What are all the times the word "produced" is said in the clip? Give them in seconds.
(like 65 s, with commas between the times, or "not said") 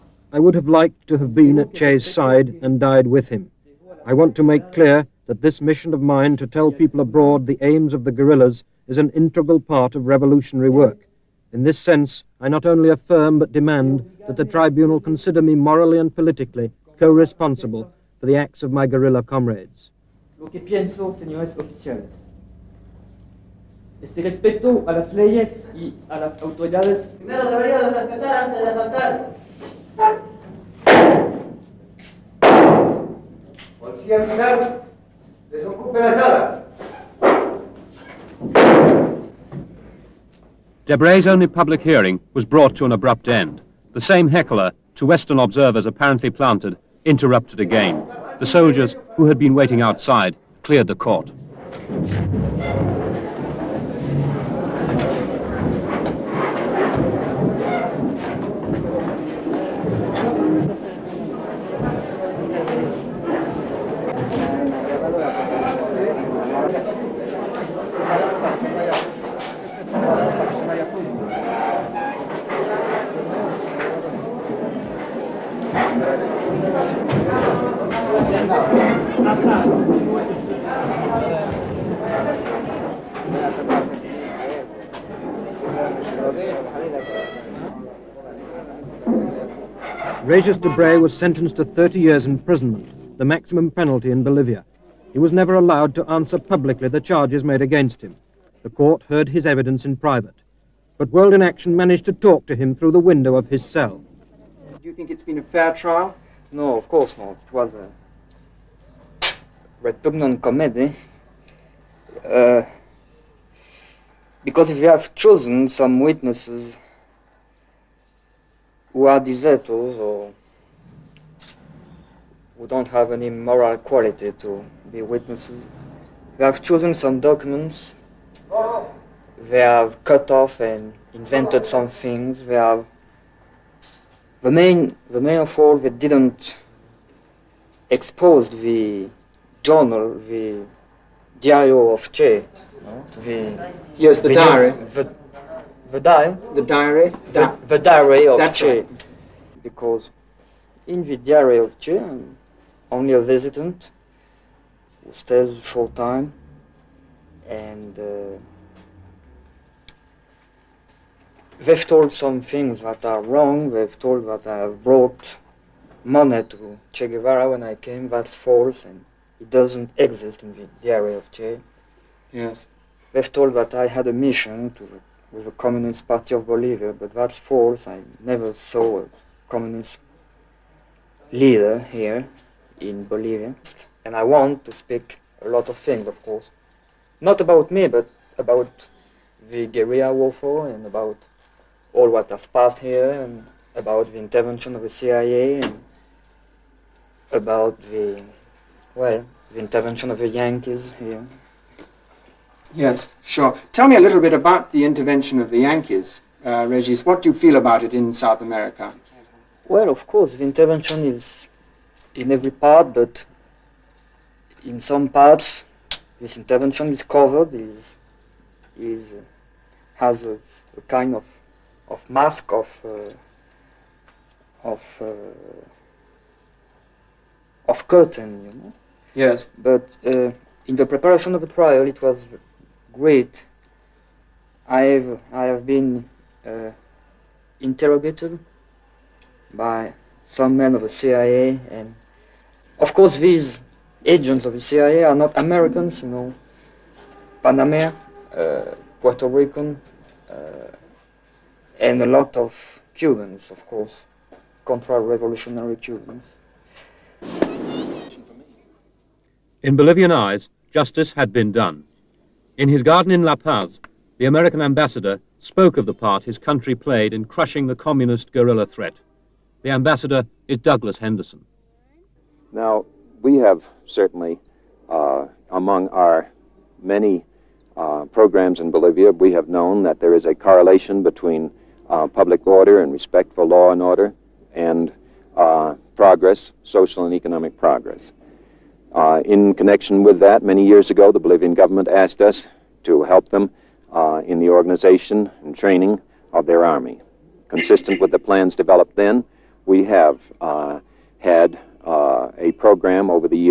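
not said.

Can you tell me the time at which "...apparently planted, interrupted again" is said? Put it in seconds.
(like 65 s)
45 s.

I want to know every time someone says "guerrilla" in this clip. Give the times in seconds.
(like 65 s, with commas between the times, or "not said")
8 s, 18 s, 189 s, 268 s.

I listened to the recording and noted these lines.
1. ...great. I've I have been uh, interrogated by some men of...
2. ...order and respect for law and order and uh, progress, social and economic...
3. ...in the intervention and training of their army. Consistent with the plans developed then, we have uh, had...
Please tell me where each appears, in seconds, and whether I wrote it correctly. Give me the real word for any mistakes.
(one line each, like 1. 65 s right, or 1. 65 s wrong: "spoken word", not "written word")
1. 232 s right
2. 282 s right
3. 294 s wrong: "organization", not "intervention".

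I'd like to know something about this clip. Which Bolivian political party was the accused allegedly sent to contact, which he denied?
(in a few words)
Communist Party of Bolivia.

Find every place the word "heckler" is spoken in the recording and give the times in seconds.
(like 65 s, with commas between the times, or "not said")
44 s.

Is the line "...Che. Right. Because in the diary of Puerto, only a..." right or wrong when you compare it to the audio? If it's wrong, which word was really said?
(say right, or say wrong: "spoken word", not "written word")
wrong: "Che", not "Puerto".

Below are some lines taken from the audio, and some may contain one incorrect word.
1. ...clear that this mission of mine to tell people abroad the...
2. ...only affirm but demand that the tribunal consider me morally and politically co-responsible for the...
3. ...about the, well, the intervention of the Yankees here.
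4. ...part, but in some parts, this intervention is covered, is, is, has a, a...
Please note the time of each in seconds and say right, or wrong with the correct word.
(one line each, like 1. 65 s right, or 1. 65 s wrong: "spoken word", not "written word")
1. 4 s right
2. 12 s right
3. 197 s right
4. 212 s right.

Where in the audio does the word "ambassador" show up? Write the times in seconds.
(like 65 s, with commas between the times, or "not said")
264 s, 269 s.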